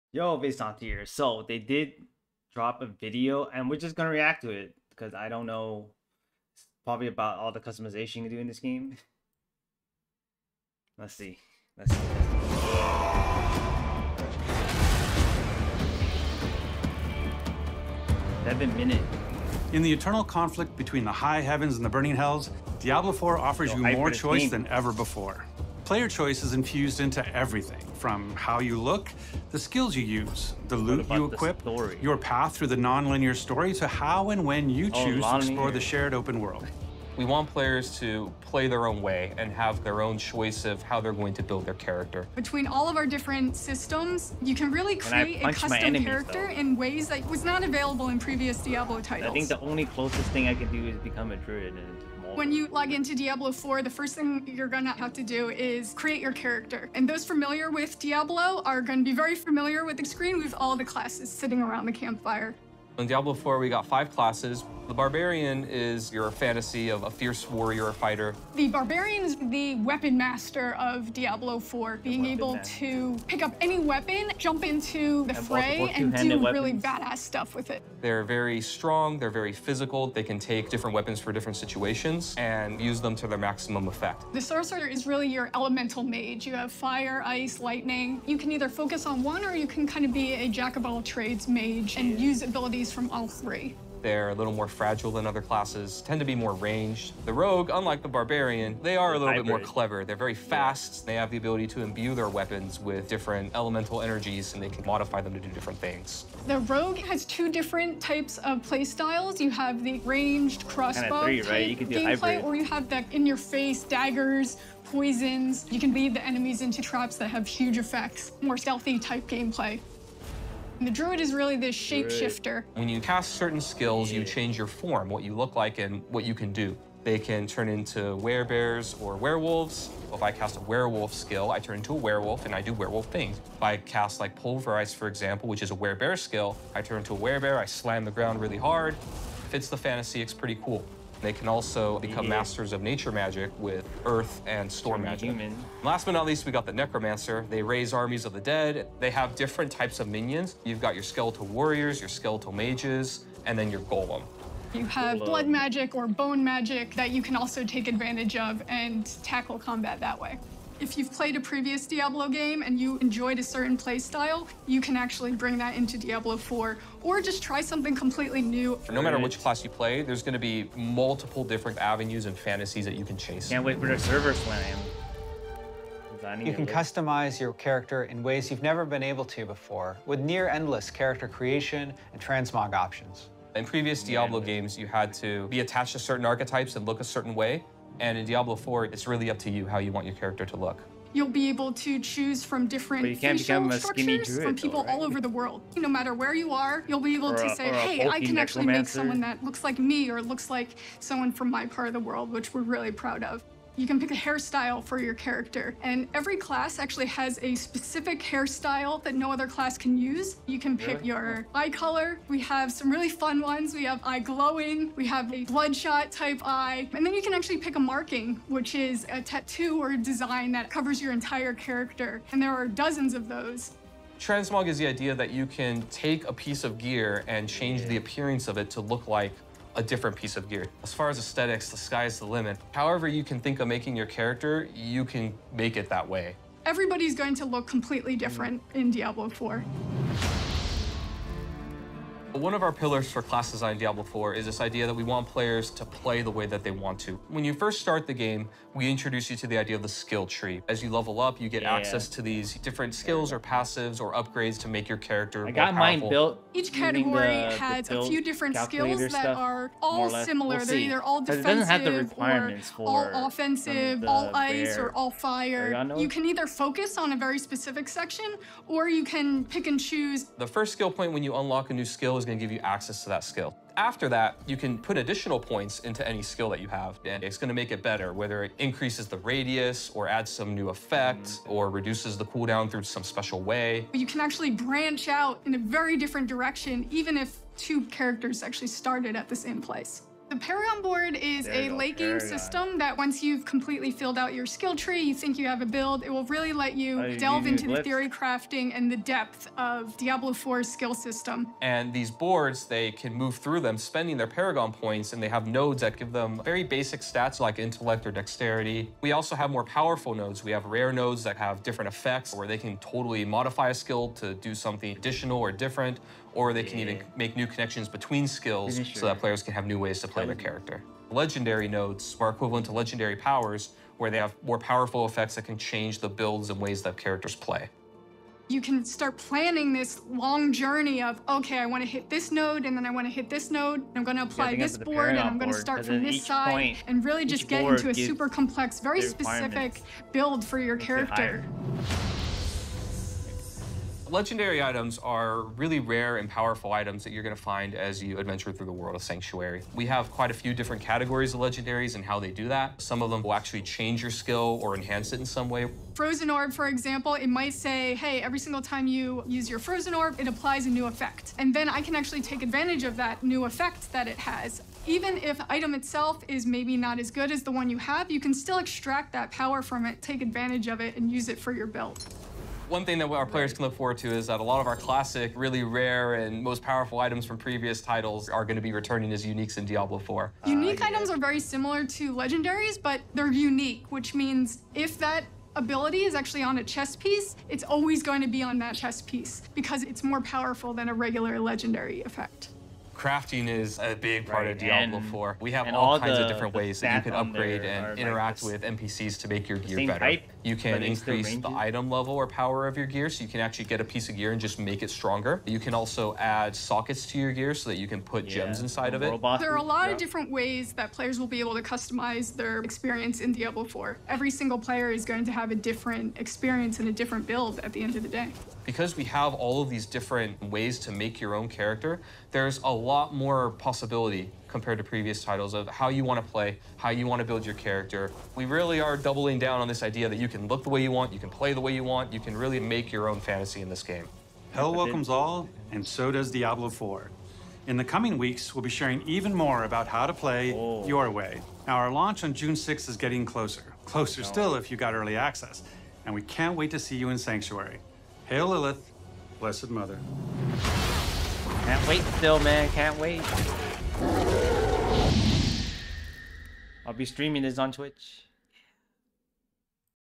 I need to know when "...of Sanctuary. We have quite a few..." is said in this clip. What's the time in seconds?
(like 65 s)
348 s.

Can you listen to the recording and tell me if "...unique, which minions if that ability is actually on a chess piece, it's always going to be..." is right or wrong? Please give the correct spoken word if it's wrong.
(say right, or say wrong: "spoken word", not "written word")
wrong: "means", not "minions".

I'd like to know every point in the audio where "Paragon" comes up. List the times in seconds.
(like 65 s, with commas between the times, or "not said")
290 s, 304 s.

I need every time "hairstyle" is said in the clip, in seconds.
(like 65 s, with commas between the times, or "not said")
204 s, 208 s.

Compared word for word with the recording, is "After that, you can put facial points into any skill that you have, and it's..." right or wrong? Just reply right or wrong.
wrong.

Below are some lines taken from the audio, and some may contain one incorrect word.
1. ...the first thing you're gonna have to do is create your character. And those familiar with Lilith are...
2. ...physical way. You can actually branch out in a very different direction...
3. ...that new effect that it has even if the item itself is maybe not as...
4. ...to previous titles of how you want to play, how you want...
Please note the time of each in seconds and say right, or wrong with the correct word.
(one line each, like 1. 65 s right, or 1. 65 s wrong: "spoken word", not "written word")
1. 53 s wrong: "Diablo", not "Lilith"
2. 283 s wrong: "special", not "physical"
3. 362 s right
4. 424 s right.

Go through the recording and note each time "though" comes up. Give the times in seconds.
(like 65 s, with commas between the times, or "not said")
46 s, 194 s.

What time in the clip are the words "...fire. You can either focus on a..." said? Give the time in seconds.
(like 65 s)
265 s.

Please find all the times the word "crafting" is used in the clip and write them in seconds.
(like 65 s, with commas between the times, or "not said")
298 s, 392 s.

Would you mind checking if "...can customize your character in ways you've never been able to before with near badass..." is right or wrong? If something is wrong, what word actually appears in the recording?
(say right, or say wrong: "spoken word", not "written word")
wrong: "endless", not "badass".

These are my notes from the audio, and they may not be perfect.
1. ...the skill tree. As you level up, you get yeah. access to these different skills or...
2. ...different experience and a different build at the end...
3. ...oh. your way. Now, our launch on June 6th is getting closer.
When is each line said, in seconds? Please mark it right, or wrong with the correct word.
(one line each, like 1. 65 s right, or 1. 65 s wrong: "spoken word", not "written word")
1. 249 s right
2. 415 s right
3. 440 s right.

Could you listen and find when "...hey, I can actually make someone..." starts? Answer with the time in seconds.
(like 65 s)
197 s.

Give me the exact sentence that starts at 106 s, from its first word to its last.
The rogue has two different types of play styles.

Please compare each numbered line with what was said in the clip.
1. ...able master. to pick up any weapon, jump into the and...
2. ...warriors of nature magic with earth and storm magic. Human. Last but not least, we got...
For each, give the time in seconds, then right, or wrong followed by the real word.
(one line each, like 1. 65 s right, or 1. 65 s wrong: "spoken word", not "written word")
1. 72 s right
2. 142 s wrong: "masters", not "warriors".